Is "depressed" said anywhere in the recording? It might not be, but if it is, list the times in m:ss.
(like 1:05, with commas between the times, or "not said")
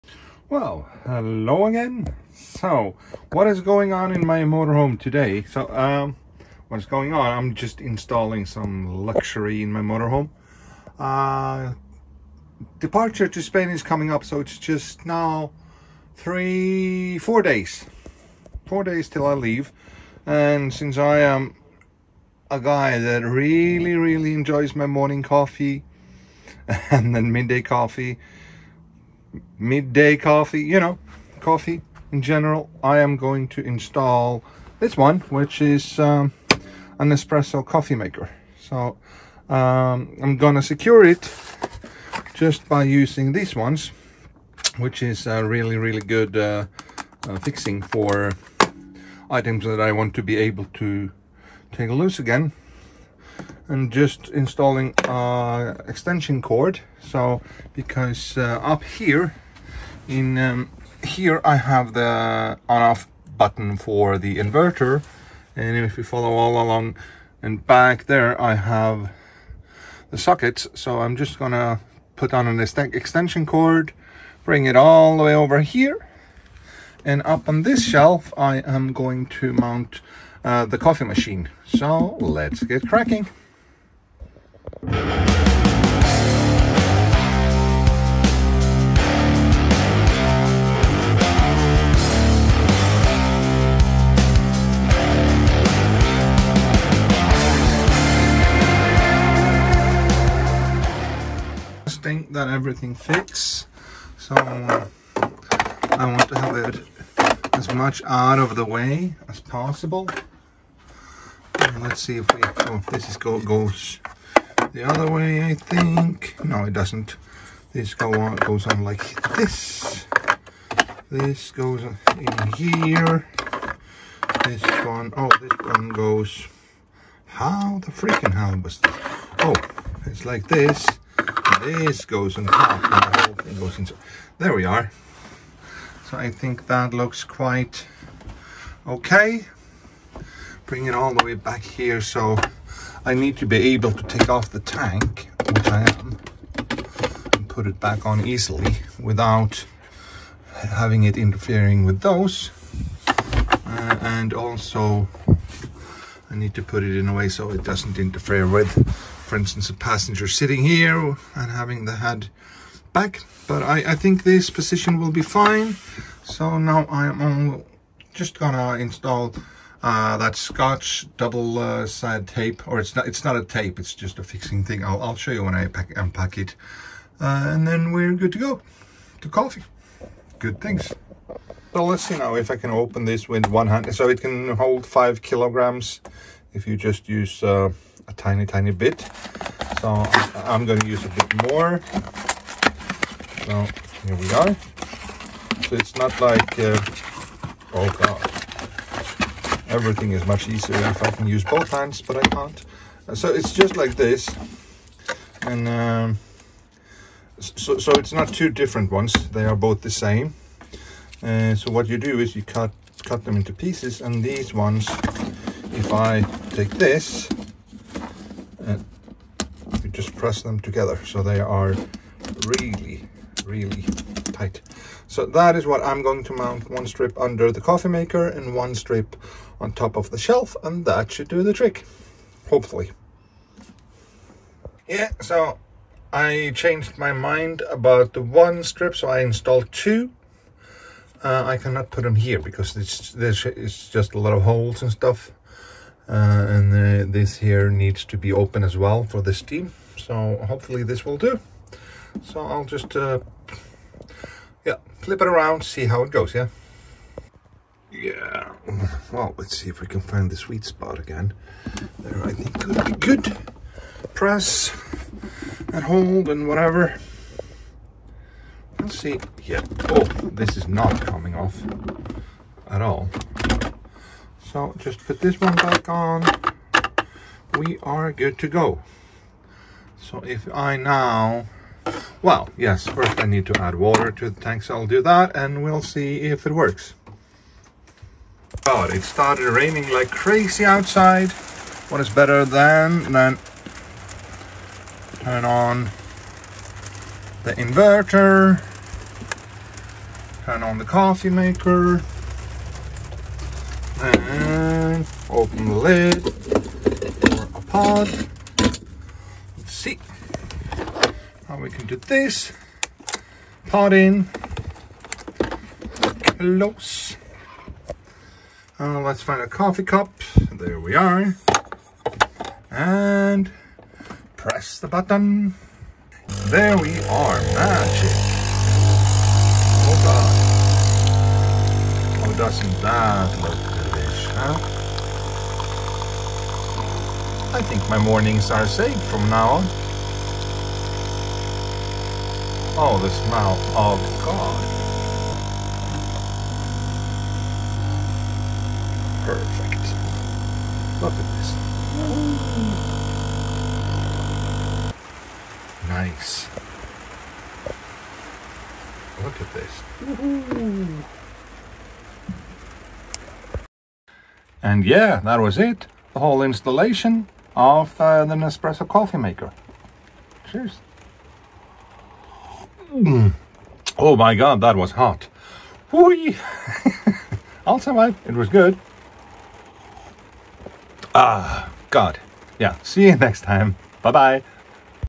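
not said.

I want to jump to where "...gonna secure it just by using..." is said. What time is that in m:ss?
0:40.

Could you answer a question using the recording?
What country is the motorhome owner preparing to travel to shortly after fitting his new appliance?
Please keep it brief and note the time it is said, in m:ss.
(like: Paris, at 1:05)
Spain, at 0:13.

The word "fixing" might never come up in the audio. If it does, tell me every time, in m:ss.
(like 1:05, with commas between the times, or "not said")
0:47, 2:54.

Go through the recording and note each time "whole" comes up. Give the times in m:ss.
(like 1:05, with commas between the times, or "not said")
2:13, 6:06.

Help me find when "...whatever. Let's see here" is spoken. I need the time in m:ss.
4:26.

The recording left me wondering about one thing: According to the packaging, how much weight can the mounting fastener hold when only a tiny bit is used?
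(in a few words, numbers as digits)
5 kilograms.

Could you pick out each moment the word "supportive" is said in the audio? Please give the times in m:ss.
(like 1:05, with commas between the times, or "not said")
not said.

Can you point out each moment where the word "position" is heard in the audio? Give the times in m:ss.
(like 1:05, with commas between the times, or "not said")
2:44.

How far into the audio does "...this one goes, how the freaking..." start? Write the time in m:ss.
2:05.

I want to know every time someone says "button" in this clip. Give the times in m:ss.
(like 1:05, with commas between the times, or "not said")
1:03, 5:24.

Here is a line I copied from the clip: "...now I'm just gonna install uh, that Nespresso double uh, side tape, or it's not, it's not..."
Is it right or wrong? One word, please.
wrong.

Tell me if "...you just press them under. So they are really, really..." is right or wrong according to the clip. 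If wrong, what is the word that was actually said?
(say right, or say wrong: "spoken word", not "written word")
wrong: "together", not "under".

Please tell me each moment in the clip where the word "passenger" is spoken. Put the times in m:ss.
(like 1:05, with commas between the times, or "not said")
2:39.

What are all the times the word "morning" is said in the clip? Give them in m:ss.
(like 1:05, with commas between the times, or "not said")
0:24, 5:37.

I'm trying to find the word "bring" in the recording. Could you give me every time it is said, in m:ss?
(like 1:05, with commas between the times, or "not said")
1:14, 2:20.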